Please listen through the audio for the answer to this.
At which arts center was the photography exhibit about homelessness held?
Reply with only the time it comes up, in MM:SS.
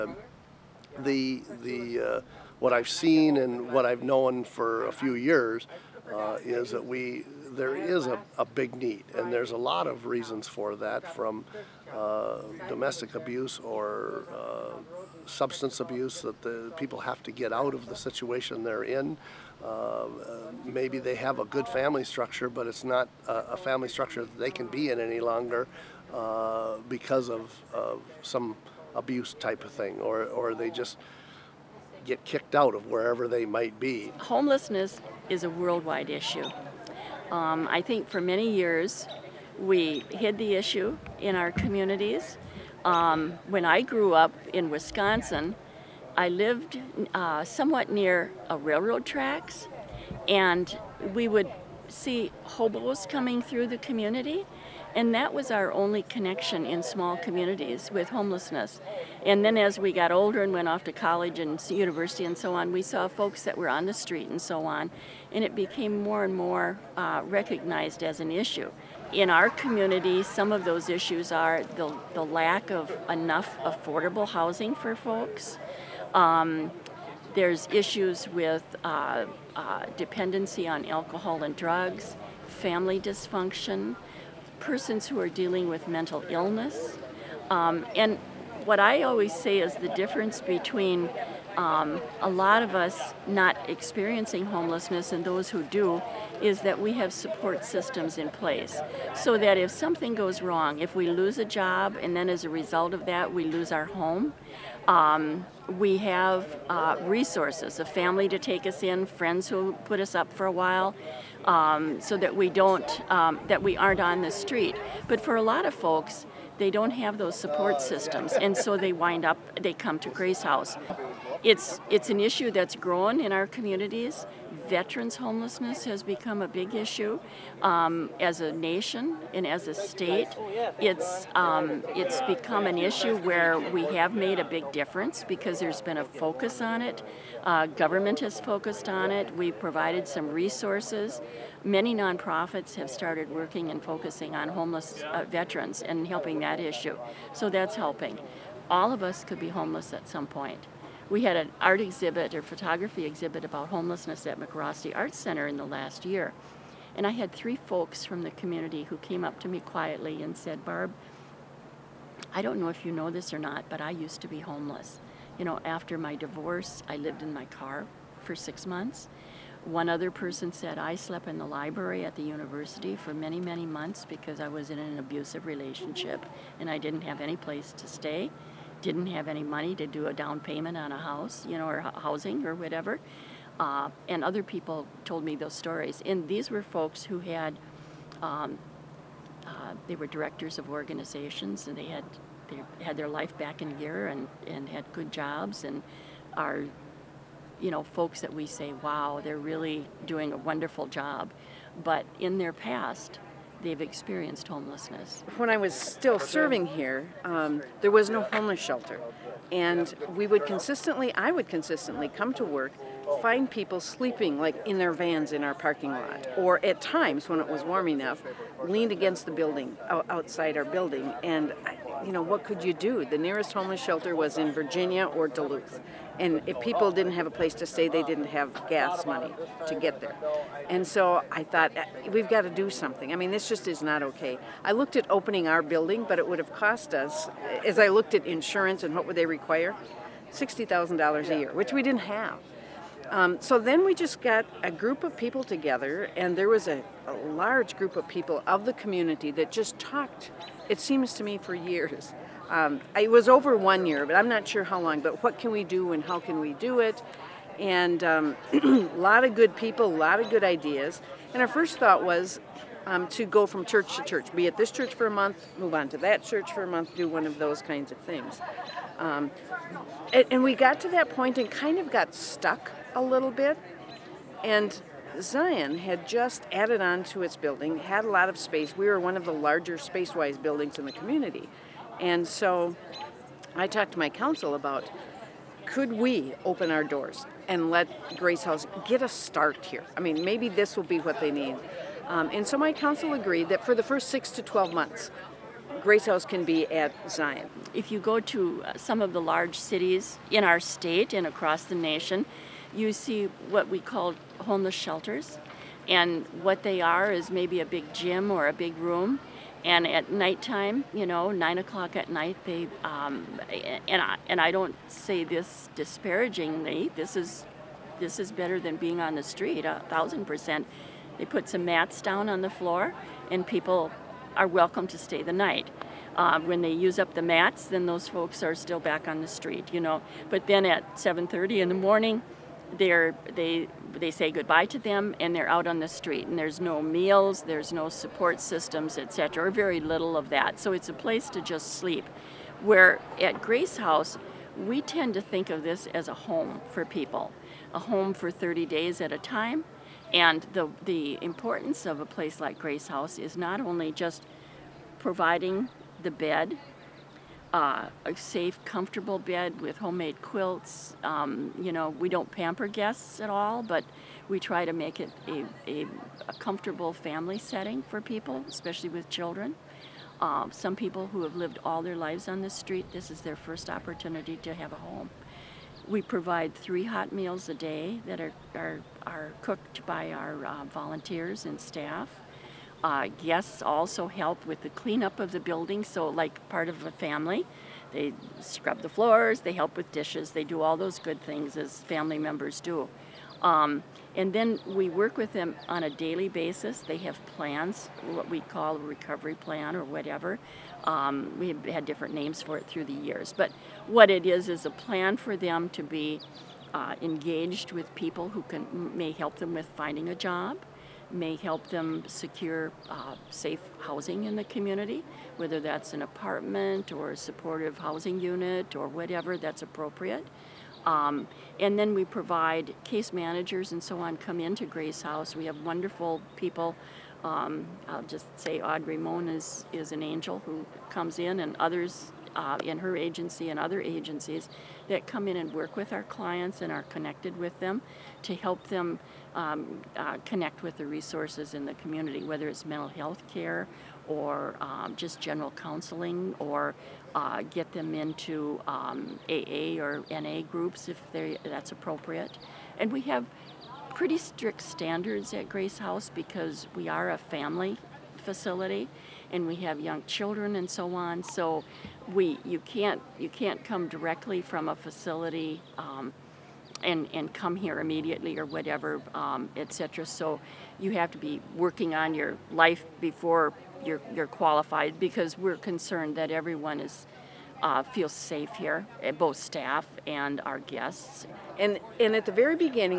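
02:34.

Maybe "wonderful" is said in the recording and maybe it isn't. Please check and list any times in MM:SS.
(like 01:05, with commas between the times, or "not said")
03:20, 07:05.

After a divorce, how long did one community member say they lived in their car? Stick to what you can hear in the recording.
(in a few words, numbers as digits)
6 months.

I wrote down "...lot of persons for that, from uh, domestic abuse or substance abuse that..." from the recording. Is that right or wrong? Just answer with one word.
wrong.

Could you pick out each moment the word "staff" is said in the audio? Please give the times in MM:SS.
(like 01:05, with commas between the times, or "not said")
06:21, 07:59.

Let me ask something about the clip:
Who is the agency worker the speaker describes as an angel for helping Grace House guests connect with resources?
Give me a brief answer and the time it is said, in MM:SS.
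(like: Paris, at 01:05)
Audrey Moan, at 07:08.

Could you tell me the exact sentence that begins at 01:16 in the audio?
Um, there's issues with uh, uh, dependency on alcohol and drugs, family dysfunction, persons who are dealing with mental illness.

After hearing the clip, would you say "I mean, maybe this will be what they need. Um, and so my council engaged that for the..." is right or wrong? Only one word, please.
wrong.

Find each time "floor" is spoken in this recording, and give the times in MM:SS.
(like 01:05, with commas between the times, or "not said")
05:22, 06:28.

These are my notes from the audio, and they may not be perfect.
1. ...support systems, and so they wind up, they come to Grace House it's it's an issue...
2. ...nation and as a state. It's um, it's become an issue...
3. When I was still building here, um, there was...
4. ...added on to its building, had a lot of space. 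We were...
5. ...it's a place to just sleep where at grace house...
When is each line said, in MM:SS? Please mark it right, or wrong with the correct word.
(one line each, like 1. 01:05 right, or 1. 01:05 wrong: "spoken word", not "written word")
1. 01:57 right
2. 02:08 right
3. 03:25 wrong: "serving", not "building"
4. 04:36 right
5. 05:40 right.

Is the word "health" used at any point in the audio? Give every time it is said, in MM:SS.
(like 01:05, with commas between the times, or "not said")
07:22.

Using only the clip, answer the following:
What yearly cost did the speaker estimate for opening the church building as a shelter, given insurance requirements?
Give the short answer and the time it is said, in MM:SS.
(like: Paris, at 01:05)
$60,000, at 04:00.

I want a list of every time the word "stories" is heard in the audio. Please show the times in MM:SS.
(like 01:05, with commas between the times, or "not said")
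03:05.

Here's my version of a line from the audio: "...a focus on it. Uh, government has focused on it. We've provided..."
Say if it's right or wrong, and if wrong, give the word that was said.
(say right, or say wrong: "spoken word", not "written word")
right.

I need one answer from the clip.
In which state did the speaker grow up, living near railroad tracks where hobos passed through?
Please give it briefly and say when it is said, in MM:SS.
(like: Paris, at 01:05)
Wisconsin, at 00:44.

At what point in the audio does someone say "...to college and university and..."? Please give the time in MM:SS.
01:00.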